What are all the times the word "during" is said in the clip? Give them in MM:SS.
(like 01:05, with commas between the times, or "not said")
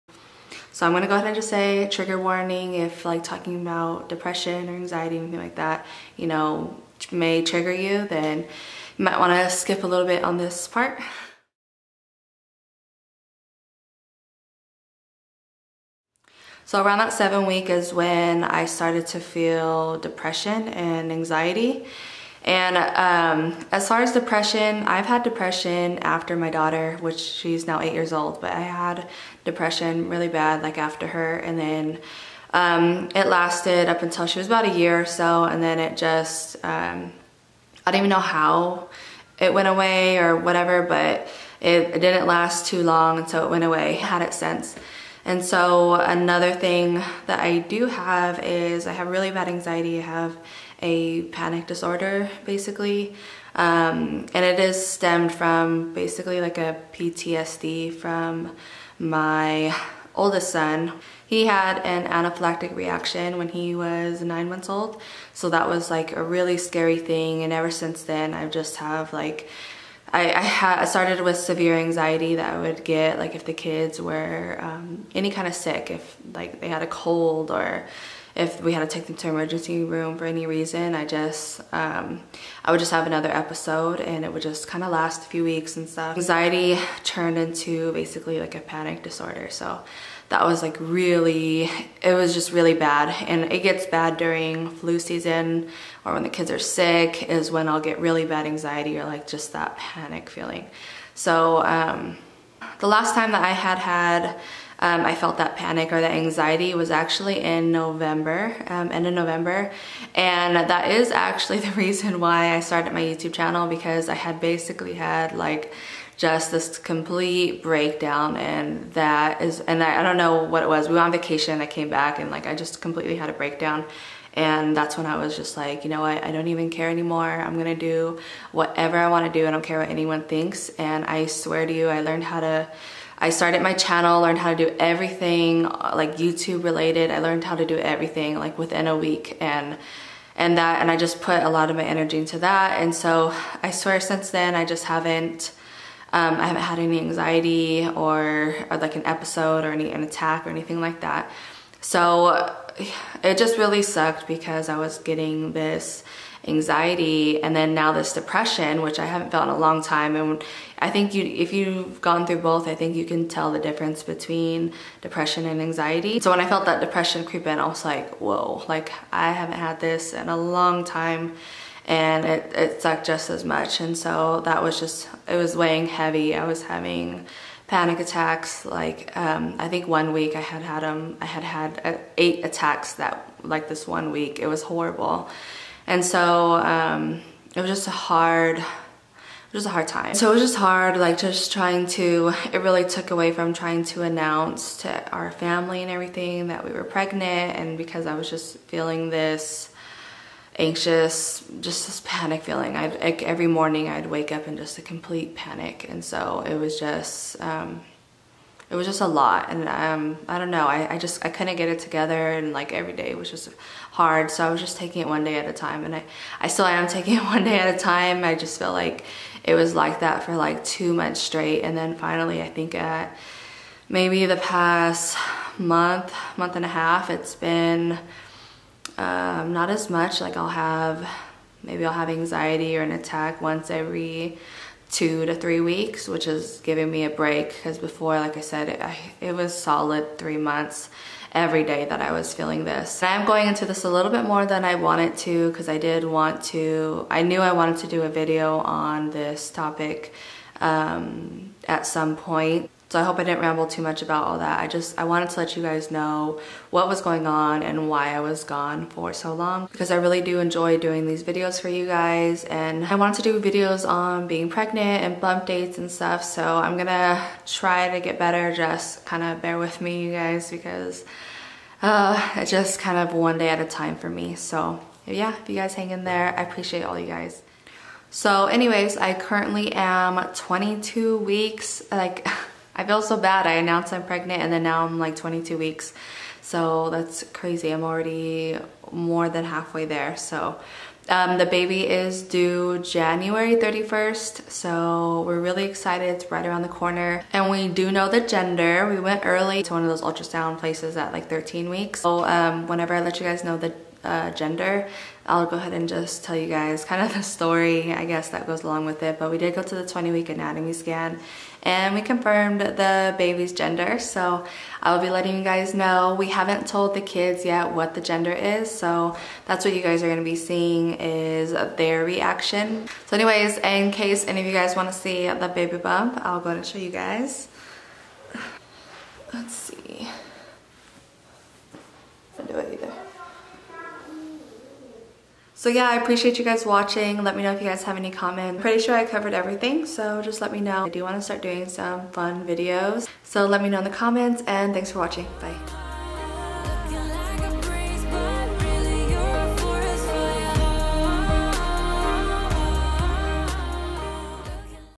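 01:34.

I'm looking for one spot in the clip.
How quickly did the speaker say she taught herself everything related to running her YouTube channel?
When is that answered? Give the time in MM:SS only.
02:18.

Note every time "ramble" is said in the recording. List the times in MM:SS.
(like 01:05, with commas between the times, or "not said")
04:13.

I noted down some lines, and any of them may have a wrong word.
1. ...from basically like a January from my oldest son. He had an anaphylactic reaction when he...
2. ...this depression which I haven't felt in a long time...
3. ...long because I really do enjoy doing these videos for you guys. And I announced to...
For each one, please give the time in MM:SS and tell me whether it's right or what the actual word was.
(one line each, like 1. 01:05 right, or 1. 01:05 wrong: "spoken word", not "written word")
1. 00:55 wrong: "PTSD", not "January"
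2. 02:37 right
3. 04:19 wrong: "wanted", not "announced".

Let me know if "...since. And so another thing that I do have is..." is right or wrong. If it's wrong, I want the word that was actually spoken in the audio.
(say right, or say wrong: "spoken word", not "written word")
right.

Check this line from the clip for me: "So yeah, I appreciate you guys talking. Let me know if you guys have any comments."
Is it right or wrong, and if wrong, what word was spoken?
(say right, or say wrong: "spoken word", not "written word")
wrong: "watching", not "talking".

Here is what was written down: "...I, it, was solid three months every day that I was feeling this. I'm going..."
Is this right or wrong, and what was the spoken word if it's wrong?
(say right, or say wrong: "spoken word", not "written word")
right.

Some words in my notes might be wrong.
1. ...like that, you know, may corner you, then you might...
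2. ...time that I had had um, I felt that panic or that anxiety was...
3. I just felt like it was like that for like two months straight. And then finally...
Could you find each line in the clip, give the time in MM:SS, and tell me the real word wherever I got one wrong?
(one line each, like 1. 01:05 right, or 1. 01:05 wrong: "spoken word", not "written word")
1. 00:05 wrong: "trigger", not "corner"
2. 01:43 right
3. 03:38 right.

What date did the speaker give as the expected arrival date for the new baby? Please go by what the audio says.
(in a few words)
January 31st.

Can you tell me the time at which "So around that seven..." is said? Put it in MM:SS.
00:16.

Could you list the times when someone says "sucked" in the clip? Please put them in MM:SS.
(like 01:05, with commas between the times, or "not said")
02:33, 02:52.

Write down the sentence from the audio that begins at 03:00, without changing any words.
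Um, I had had uh, eight attacks that like this one week.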